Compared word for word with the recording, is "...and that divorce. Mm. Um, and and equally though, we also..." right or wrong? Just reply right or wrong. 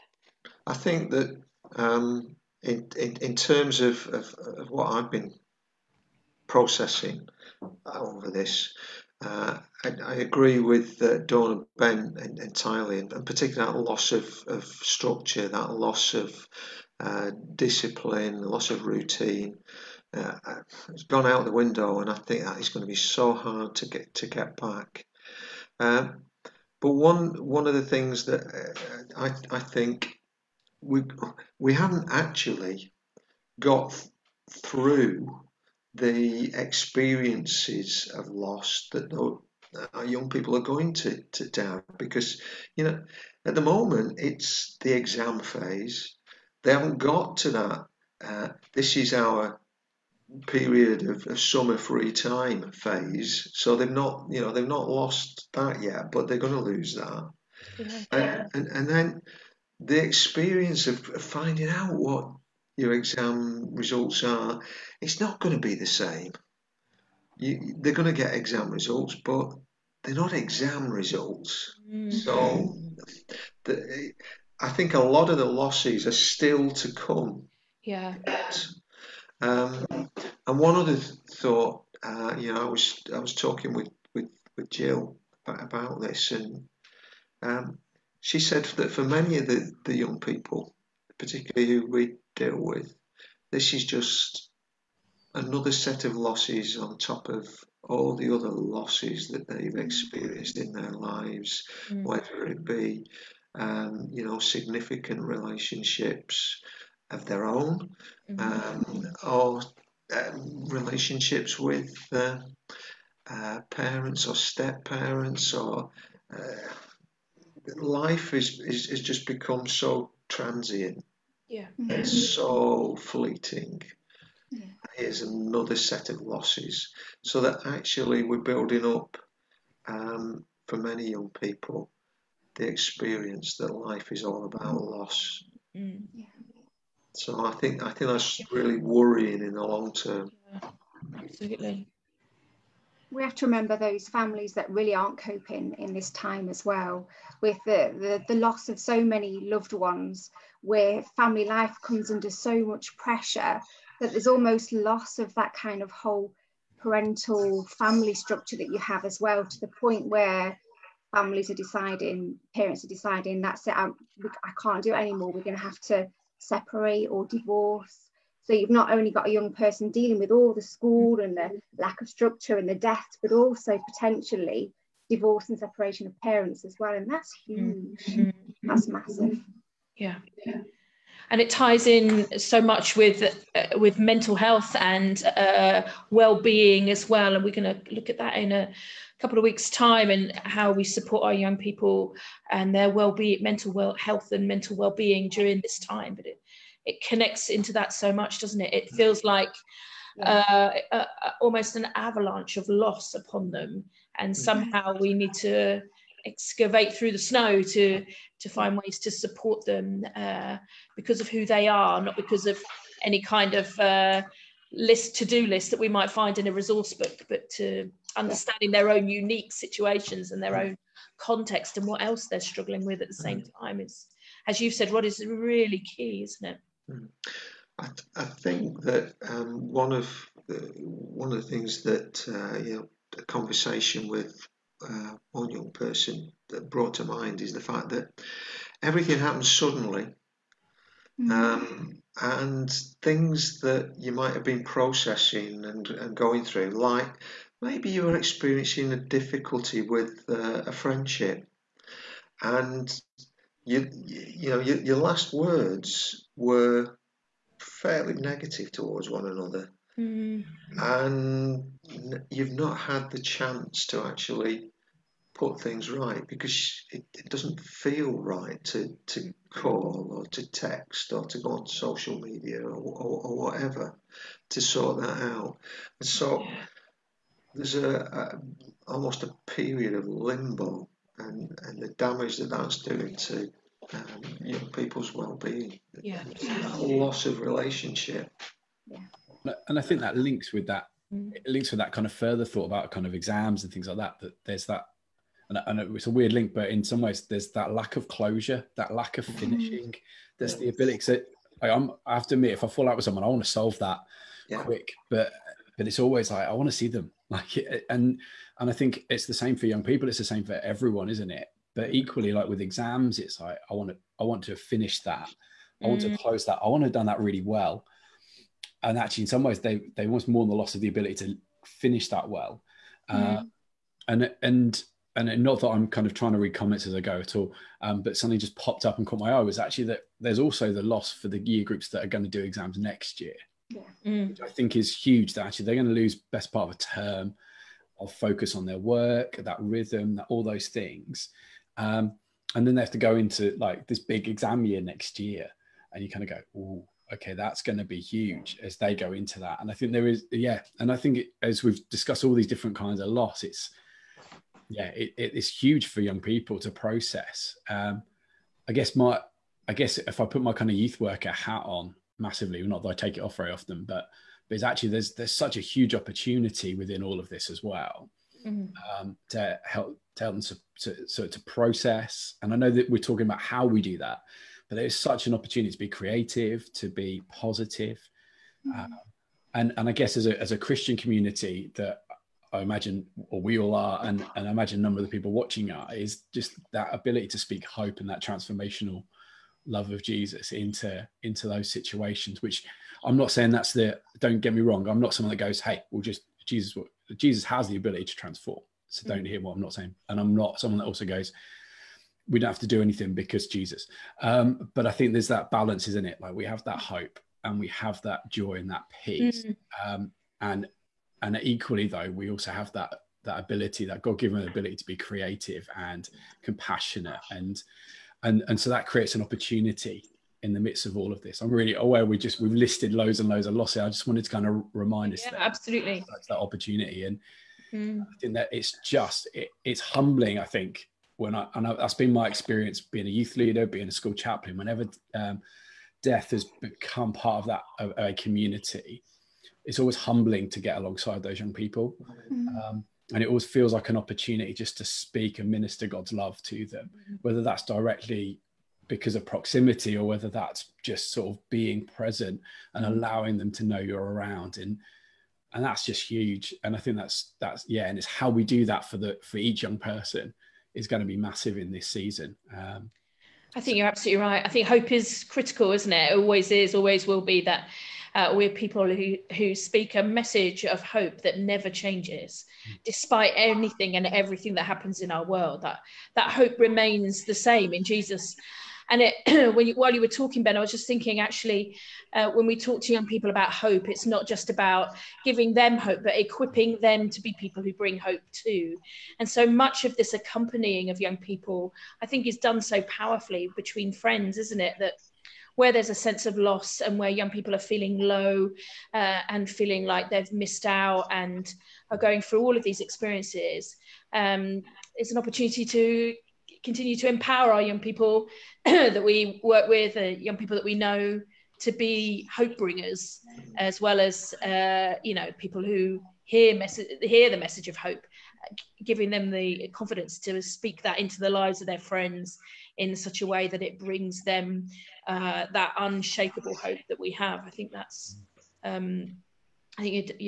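wrong.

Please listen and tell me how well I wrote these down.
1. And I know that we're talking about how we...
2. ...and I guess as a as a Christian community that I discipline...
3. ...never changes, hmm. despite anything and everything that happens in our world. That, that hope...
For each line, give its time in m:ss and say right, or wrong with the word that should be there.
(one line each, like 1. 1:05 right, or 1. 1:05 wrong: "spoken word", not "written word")
1. 6:12 right
2. 6:19 wrong: "imagine", not "discipline"
3. 7:51 right.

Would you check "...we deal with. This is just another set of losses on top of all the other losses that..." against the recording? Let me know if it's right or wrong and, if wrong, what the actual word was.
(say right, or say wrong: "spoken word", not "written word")
right.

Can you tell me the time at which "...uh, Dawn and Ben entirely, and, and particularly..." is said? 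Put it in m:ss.
0:11.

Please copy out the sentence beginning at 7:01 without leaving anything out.
I'm really aware we just we've listed loads and loads of losses.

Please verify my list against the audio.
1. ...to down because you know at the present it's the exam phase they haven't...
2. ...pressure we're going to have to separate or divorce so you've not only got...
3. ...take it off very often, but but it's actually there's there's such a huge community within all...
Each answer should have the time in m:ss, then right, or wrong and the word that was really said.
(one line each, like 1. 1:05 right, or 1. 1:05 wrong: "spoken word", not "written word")
1. 0:41 wrong: "moment", not "present"
2. 2:44 wrong: "anymore", not "pressure"
3. 6:02 wrong: "opportunity", not "community".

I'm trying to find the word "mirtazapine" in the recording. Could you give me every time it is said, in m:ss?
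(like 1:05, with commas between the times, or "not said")
not said.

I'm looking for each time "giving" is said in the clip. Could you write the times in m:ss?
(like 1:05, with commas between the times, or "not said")
8:05, 8:38.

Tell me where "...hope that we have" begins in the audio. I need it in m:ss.
8:46.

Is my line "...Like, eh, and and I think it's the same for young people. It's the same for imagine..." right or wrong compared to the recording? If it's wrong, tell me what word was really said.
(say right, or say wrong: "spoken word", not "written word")
wrong: "everyone", not "imagine".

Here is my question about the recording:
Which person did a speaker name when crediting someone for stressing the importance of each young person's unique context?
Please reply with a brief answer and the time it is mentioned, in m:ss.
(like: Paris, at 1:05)
Rod, at 3:44.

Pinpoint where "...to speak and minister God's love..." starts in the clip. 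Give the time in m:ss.
7:24.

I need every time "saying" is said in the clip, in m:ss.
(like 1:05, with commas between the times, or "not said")
6:33, 6:39.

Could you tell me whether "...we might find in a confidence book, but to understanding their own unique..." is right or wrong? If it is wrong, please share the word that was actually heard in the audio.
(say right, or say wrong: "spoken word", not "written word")
wrong: "resource", not "confidence".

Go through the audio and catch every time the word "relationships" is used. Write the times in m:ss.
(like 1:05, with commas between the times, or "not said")
1:45, 1:50, 4:47.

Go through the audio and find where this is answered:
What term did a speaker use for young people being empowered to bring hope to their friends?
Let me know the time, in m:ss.
8:32.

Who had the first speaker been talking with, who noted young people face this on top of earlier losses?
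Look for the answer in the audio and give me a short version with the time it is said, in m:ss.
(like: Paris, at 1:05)
Jill, at 1:24.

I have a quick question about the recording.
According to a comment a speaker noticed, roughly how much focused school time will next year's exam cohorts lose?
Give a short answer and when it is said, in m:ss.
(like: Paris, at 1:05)
A term, at 5:36.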